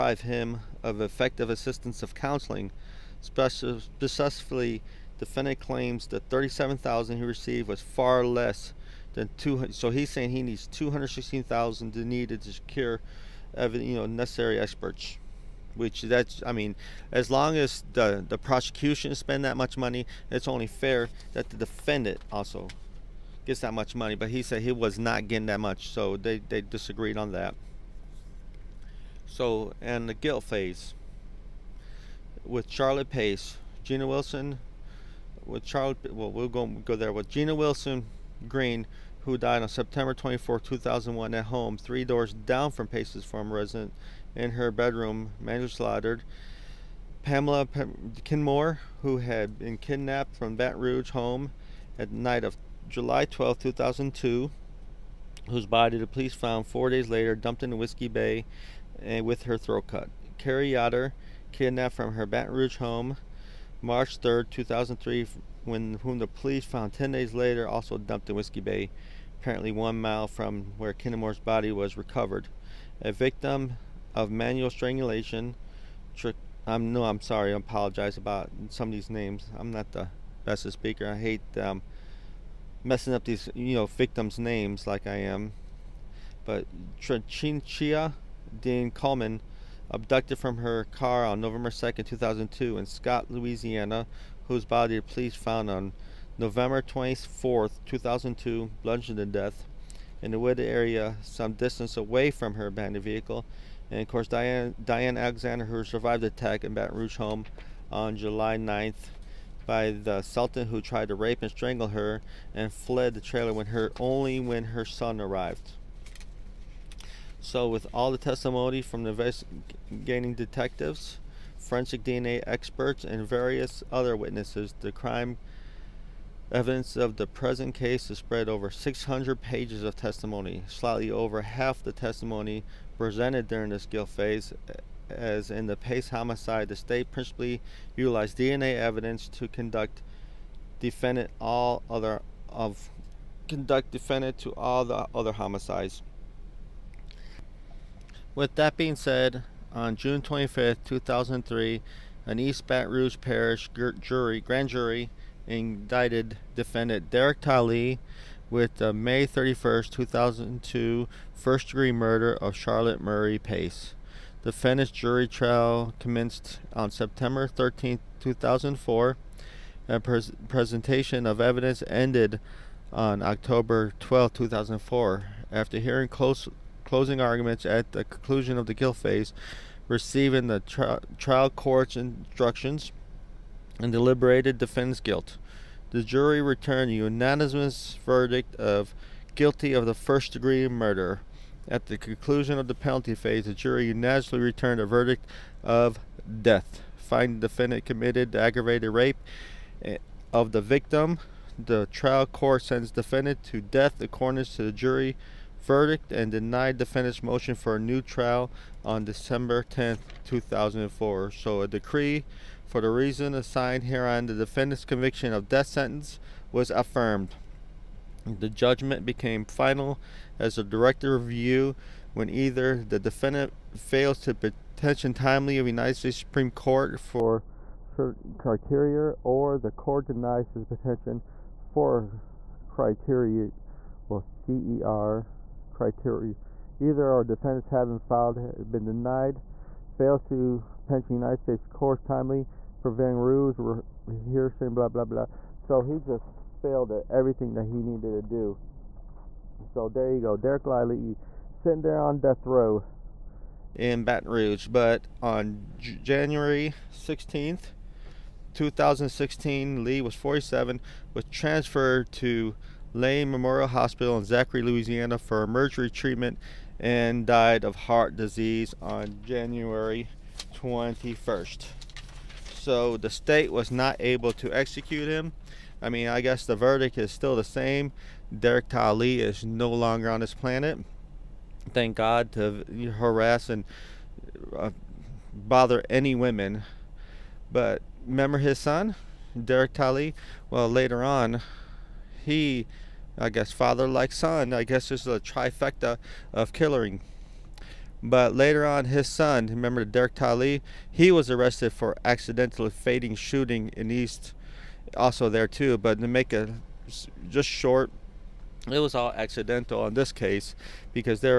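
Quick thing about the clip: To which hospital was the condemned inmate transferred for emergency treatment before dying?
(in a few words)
Lane Memorial Hospital.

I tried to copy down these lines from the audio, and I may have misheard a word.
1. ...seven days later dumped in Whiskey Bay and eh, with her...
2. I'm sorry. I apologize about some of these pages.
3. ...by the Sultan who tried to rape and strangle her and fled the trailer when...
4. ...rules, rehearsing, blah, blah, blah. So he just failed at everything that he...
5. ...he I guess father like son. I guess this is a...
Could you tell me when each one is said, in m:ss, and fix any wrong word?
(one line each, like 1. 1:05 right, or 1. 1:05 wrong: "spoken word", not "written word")
1. 0:56 wrong: "four", not "seven"
2. 1:17 wrong: "names", not "pages"
3. 1:49 right
4. 4:03 right
5. 4:52 right.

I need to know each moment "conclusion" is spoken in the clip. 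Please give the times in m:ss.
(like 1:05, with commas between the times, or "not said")
2:58, 3:11.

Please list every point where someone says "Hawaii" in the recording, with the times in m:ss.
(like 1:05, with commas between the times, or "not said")
not said.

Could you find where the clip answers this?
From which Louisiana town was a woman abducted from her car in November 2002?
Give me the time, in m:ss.
1:32.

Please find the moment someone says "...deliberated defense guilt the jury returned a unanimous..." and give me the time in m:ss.
3:03.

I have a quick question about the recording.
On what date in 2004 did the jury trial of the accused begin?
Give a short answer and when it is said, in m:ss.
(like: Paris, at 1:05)
September 13, 2004, at 2:46.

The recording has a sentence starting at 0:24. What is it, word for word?
But he said he was not getting that much, so they they disagreed on that.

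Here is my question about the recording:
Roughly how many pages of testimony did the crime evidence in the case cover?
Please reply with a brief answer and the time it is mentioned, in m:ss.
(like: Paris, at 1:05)
600, at 2:08.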